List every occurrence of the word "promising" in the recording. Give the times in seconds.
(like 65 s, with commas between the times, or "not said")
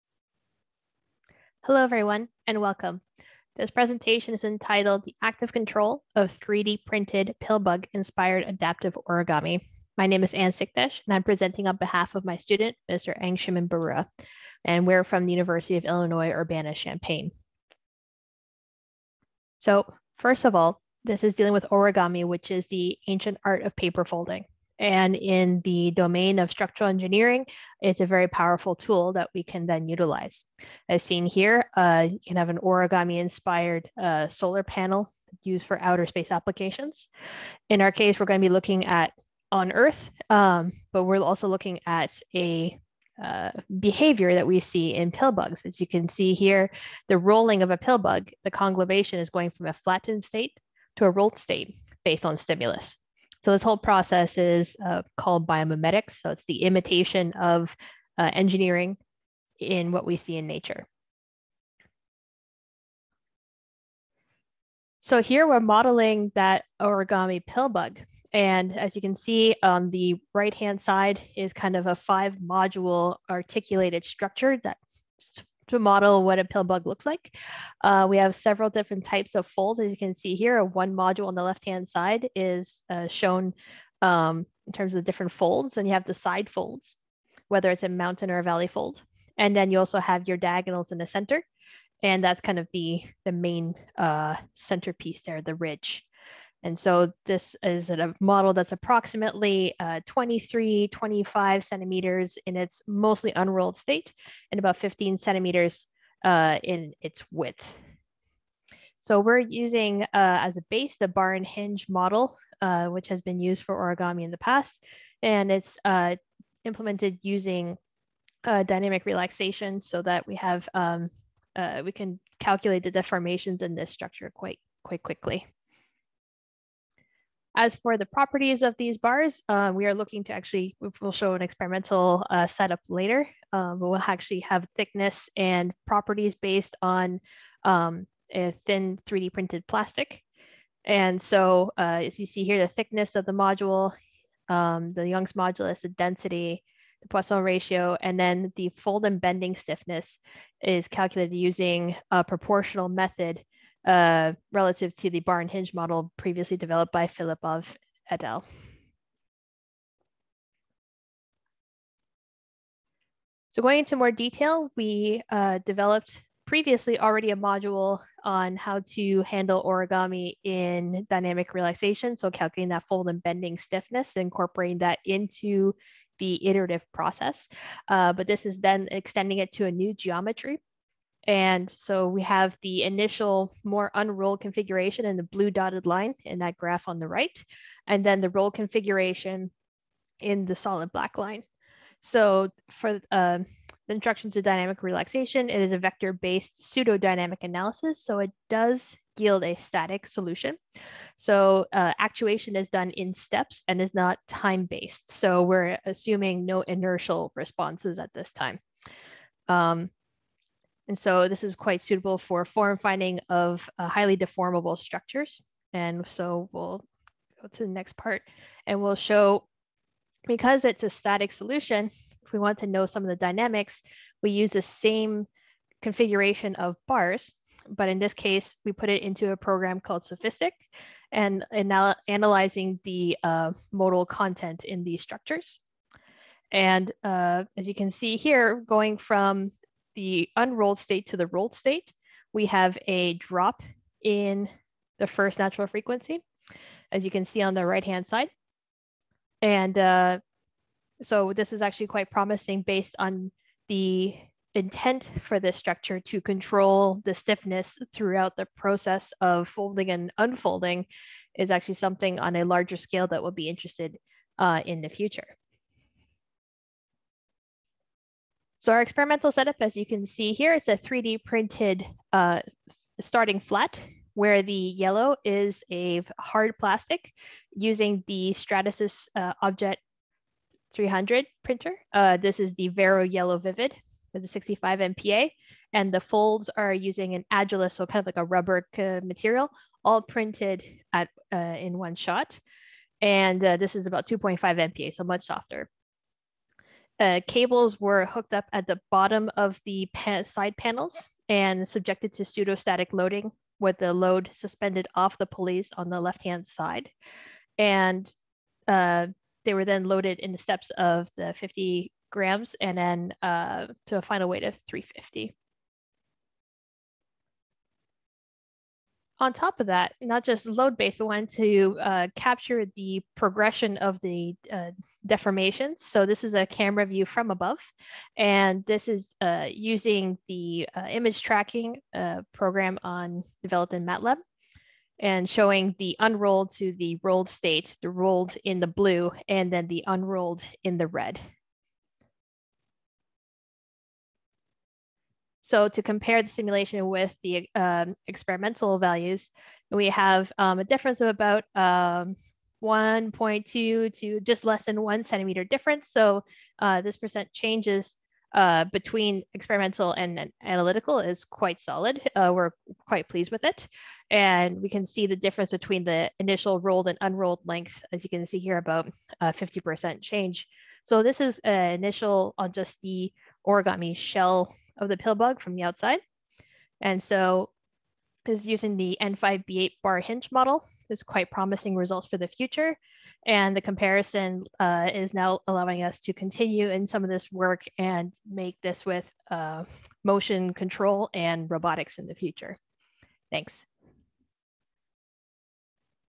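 252 s, 381 s.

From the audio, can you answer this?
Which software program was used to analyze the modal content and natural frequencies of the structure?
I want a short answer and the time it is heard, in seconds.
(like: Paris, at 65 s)
SOFiSTiK, at 230 s.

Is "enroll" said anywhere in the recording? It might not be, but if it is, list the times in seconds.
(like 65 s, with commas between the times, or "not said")
not said.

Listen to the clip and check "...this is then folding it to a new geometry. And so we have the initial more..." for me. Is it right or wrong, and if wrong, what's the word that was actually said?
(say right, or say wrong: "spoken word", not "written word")
wrong: "extending", not "folding".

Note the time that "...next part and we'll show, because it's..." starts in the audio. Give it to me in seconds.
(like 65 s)
217 s.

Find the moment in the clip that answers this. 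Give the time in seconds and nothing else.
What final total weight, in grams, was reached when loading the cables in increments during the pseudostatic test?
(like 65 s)
314 s.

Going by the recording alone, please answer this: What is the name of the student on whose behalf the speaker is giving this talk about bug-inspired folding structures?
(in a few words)
Angshuman Baruah.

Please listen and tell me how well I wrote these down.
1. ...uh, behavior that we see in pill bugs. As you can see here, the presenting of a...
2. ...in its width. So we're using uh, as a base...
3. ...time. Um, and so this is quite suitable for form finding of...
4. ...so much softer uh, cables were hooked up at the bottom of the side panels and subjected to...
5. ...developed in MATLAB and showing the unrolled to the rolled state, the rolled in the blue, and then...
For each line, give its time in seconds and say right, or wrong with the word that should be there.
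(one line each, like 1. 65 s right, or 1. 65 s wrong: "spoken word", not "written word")
1. 43 s wrong: "rolling", not "presenting"
2. 106 s right
3. 208 s right
4. 294 s right
5. 333 s right.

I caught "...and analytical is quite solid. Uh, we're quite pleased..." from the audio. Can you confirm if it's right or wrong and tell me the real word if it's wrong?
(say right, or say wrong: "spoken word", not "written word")
right.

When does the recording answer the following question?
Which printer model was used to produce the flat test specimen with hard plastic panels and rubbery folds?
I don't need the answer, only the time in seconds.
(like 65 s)
279 s.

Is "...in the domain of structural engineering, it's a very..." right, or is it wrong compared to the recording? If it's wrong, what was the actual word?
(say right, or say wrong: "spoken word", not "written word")
right.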